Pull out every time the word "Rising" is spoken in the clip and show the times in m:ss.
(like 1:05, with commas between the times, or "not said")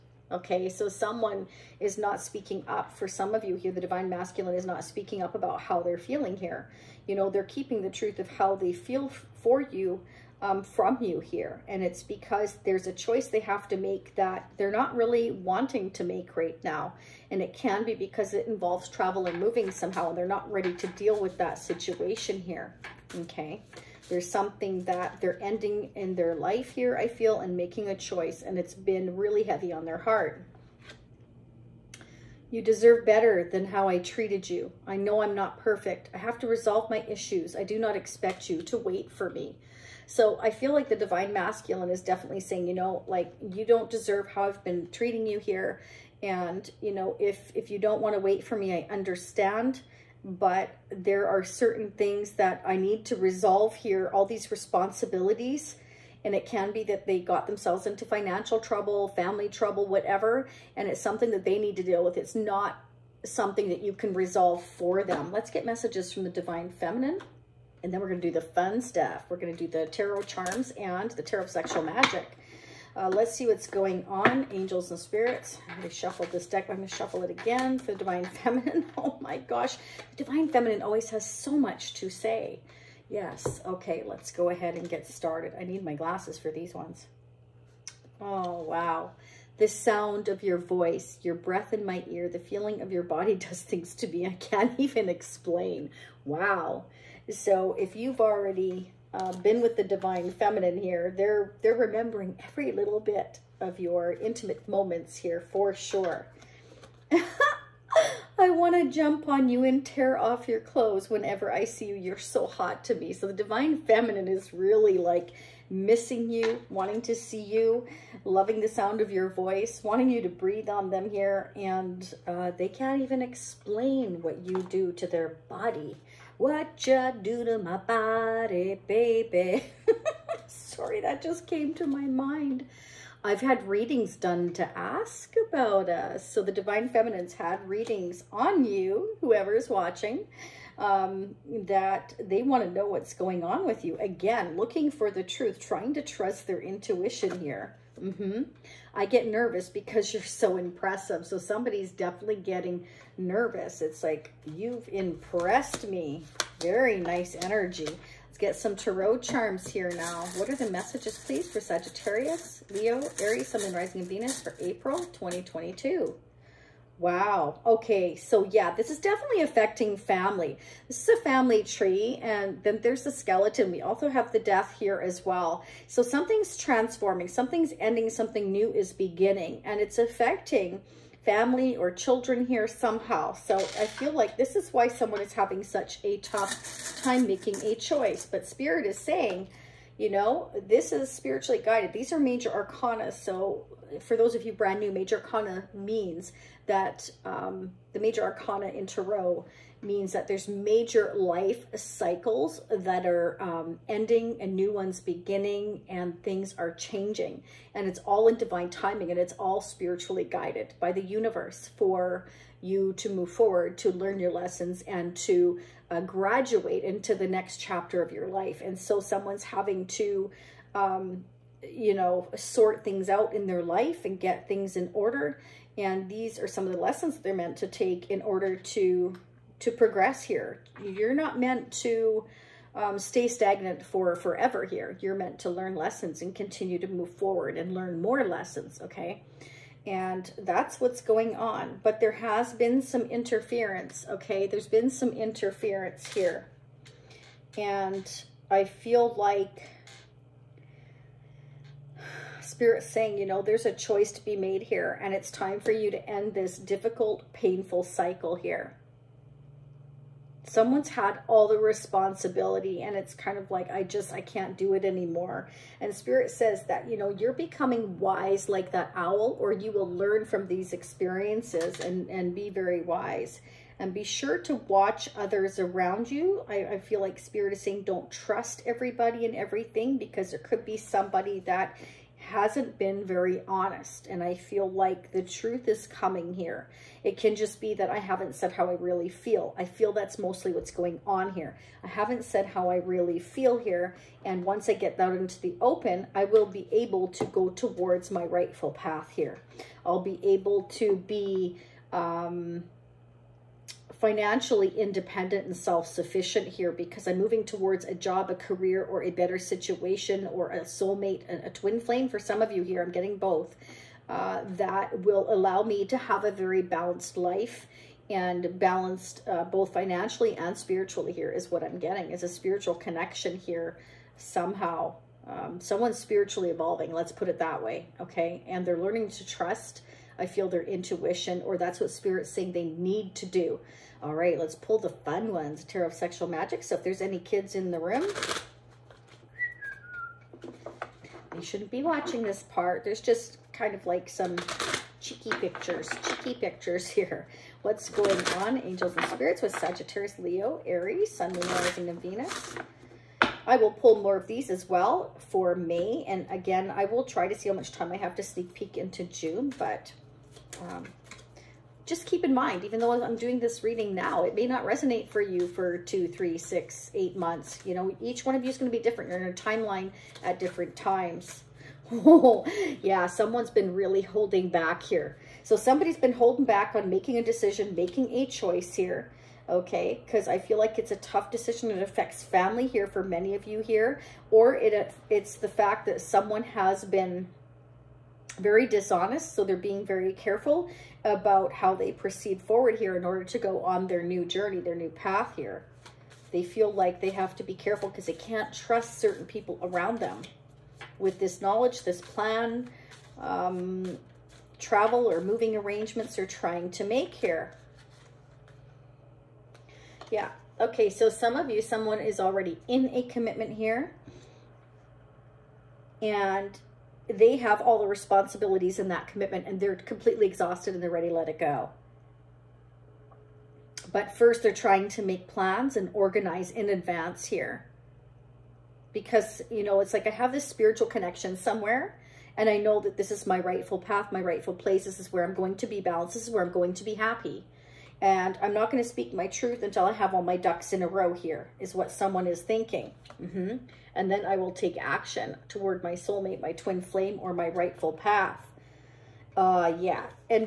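2:43, 5:51.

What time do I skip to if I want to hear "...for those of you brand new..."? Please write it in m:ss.
3:13.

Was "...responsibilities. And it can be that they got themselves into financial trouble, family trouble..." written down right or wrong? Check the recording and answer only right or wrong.
right.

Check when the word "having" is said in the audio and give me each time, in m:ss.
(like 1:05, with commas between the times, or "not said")
3:05, 3:39.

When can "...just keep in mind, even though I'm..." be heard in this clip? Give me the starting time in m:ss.
6:01.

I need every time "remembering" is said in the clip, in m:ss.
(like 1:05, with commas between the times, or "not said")
1:41.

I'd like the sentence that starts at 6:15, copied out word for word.
So somebody's been holding back on making a decision, making a choice here, okay?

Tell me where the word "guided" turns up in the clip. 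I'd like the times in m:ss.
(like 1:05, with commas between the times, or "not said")
3:11, 3:30.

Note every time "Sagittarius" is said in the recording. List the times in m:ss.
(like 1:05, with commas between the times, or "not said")
2:41, 5:49.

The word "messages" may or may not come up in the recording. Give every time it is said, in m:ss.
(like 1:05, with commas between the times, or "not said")
1:05, 2:40.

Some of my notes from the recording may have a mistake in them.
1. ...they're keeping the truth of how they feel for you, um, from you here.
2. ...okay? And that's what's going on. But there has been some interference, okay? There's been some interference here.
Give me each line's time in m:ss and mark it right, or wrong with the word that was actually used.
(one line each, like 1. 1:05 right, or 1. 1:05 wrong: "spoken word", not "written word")
1. 0:07 right
2. 3:58 right.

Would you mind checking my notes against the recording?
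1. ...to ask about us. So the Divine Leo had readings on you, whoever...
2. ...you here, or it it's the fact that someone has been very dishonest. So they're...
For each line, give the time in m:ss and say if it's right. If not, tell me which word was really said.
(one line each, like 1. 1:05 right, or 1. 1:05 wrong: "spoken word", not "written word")
1. 2:14 wrong: "Feminines", not "Leo"
2. 6:23 right.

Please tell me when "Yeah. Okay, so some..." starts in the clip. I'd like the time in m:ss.
6:50.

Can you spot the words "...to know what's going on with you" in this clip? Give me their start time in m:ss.
2:22.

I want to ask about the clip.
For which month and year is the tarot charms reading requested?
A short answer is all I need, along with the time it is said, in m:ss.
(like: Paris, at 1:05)
April 2022, at 2:44.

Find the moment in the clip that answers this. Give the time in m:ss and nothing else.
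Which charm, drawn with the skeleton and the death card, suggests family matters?
2:51.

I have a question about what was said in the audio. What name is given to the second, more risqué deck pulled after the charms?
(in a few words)
Tarot of Sexual Magic.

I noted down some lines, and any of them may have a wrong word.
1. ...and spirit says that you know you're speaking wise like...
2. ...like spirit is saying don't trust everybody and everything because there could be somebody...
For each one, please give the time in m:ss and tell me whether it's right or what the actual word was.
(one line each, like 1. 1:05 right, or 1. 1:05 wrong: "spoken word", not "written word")
1. 4:25 wrong: "becoming", not "speaking"
2. 4:36 right.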